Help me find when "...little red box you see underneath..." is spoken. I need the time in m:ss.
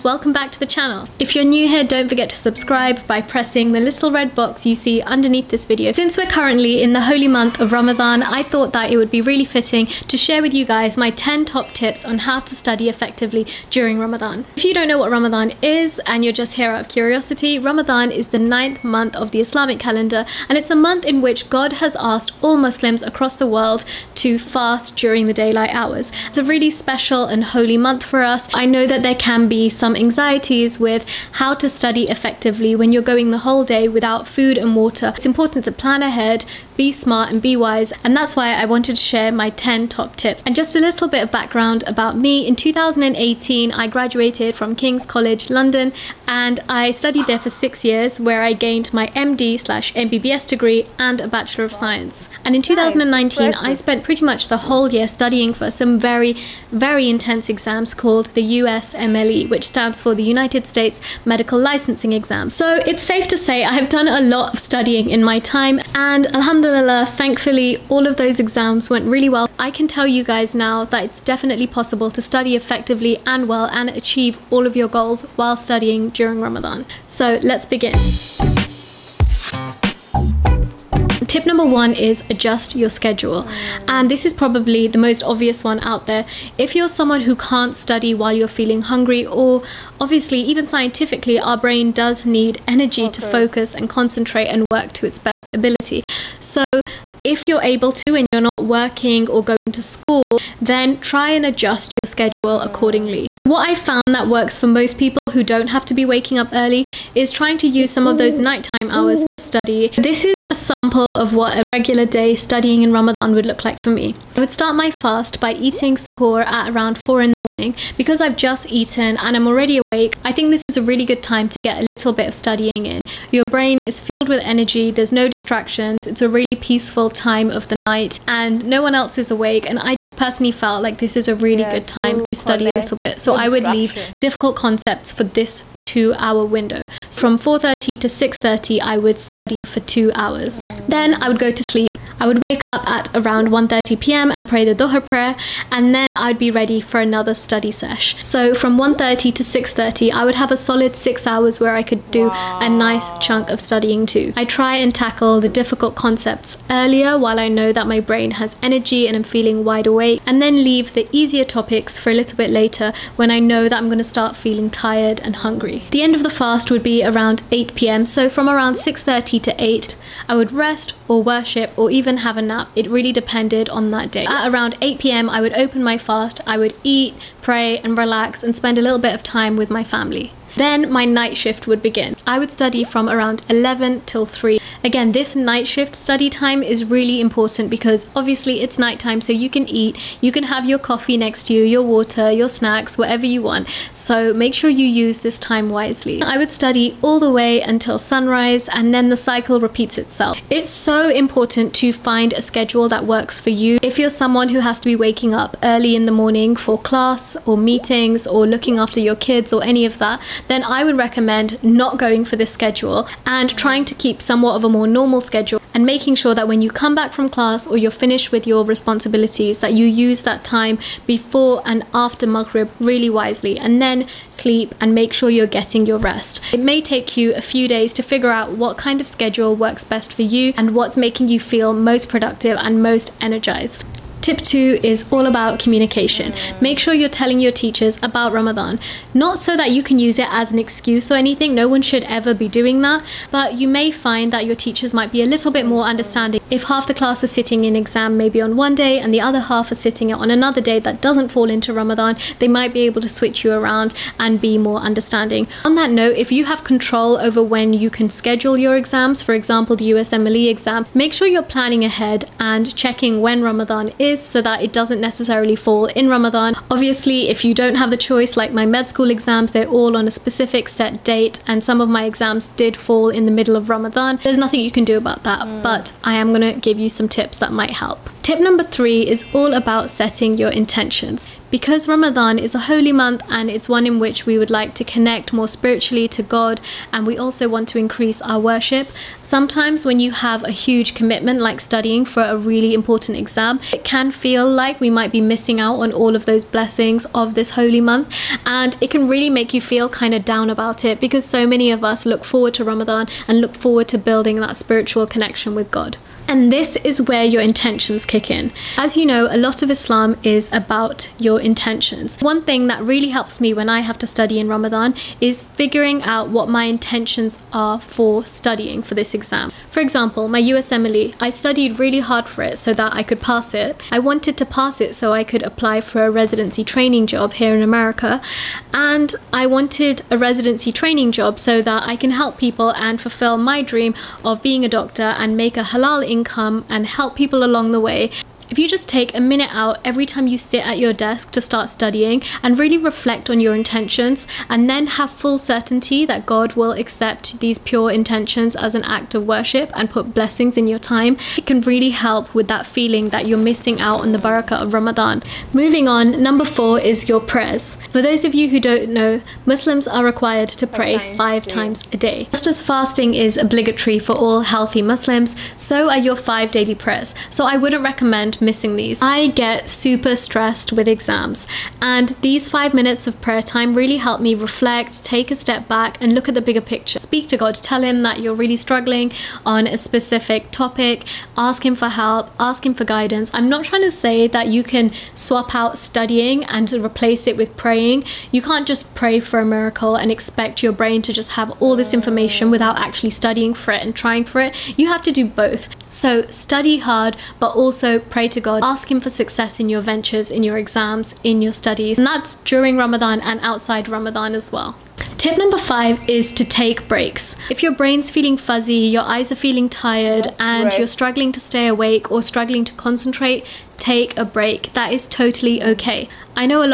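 0:03.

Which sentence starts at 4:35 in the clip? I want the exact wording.
but I am gonna give you some tips that might help.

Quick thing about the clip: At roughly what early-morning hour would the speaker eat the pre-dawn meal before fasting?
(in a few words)
4.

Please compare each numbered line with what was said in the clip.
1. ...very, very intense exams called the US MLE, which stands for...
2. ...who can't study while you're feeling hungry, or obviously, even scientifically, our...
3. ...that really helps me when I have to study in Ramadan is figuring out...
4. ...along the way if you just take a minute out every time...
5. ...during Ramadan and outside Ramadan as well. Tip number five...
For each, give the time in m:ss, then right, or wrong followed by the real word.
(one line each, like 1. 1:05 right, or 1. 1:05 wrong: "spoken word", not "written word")
1. 0:55 right
2. 1:27 right
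3. 5:12 right
4. 5:37 right
5. 6:42 right.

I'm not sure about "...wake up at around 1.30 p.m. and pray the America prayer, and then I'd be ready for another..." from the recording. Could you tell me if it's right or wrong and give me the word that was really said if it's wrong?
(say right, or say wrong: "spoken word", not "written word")
wrong: "Dhuhr", not "America".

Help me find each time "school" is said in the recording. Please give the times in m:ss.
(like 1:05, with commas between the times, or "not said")
1:39, 4:28.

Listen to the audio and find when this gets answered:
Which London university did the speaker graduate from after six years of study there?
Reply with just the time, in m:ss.
0:44.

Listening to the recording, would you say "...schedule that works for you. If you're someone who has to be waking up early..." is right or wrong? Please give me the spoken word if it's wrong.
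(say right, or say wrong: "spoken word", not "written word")
right.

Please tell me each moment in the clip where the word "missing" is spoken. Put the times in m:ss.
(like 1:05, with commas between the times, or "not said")
4:55, 5:53, 6:08.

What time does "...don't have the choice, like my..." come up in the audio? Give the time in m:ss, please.
4:27.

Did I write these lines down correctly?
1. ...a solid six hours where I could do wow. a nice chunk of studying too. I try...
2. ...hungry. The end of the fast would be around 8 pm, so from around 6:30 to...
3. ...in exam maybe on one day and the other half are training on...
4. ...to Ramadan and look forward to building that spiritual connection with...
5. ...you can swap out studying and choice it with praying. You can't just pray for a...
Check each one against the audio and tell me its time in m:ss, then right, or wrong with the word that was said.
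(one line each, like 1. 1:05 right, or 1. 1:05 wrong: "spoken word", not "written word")
1. 2:30 right
2. 2:45 right
3. 4:07 wrong: "sitting", not "training"
4. 5:02 right
5. 6:24 wrong: "replace", not "choice".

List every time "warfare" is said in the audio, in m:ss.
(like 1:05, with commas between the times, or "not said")
not said.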